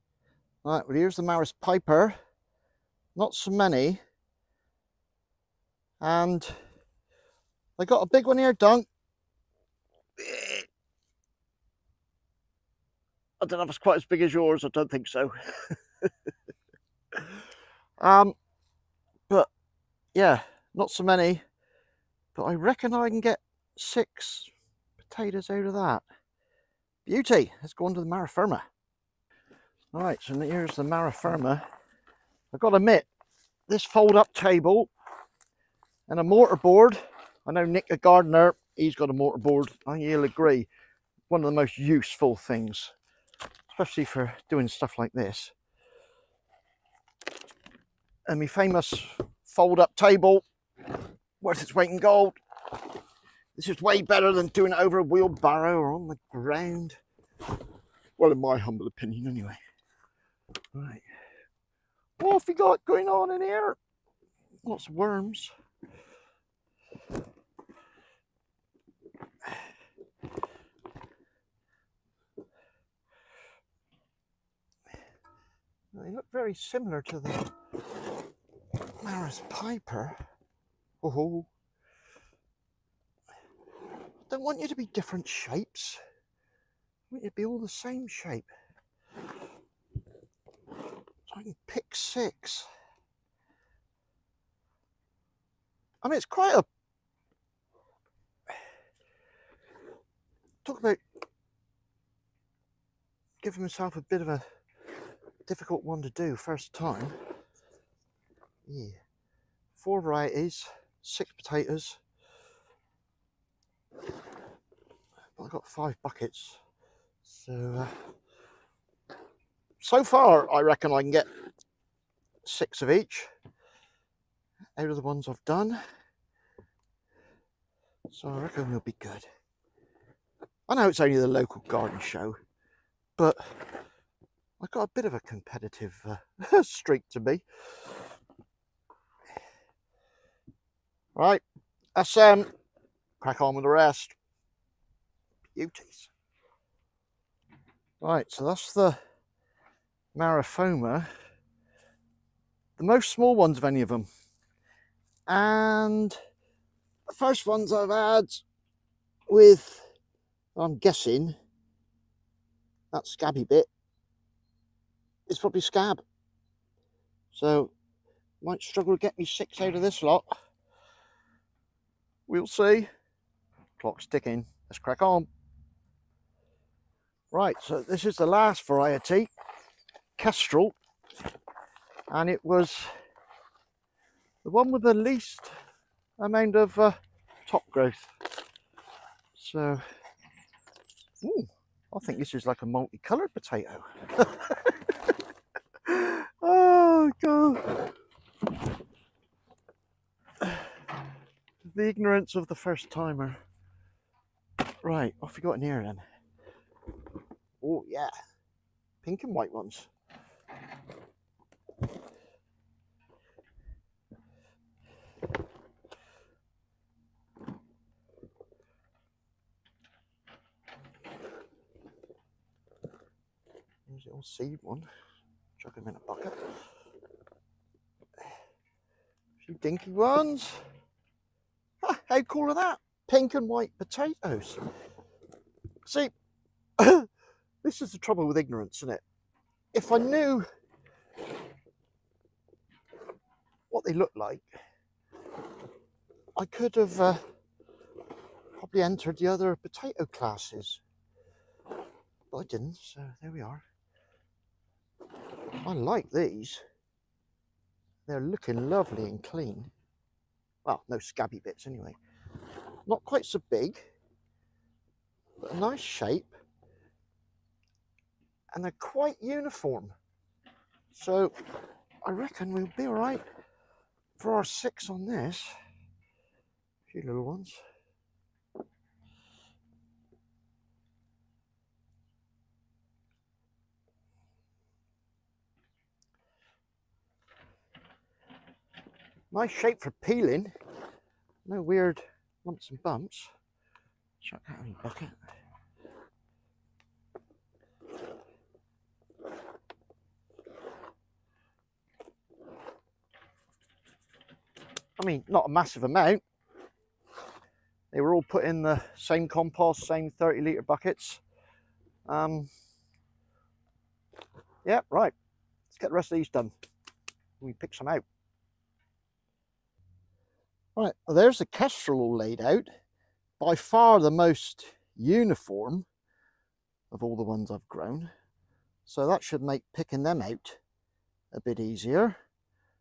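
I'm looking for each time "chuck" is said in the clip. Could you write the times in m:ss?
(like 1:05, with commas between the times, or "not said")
3:45, 4:54.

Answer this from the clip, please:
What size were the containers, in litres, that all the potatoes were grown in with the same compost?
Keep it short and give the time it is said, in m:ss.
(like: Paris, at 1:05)
30 litres, at 5:10.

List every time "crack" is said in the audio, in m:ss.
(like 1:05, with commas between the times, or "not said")
2:23, 2:54.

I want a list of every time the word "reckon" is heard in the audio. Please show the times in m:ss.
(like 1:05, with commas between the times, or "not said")
0:22, 2:00, 2:08, 4:32.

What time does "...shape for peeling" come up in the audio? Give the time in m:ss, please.
4:49.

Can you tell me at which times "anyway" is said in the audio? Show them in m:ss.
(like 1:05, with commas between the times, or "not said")
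0:59, 4:21.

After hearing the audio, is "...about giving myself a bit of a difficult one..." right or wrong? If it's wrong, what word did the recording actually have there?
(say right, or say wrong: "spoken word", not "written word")
right.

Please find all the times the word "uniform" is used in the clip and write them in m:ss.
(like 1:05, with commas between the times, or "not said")
4:29, 5:24.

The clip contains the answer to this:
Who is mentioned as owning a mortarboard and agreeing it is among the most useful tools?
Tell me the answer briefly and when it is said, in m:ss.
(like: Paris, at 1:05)
Nick the gardener, at 0:37.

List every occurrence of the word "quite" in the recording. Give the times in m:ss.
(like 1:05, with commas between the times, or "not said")
0:13, 1:36, 4:23, 4:28.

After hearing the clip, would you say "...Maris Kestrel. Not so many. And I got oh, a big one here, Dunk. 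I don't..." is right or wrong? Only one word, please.
wrong.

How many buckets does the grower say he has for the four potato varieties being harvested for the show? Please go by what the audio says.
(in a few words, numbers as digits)
5.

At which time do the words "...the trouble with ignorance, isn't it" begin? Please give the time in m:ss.
3:57.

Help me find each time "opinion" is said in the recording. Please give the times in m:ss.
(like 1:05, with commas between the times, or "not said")
0:58.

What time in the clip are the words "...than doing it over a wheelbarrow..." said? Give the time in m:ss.
0:54.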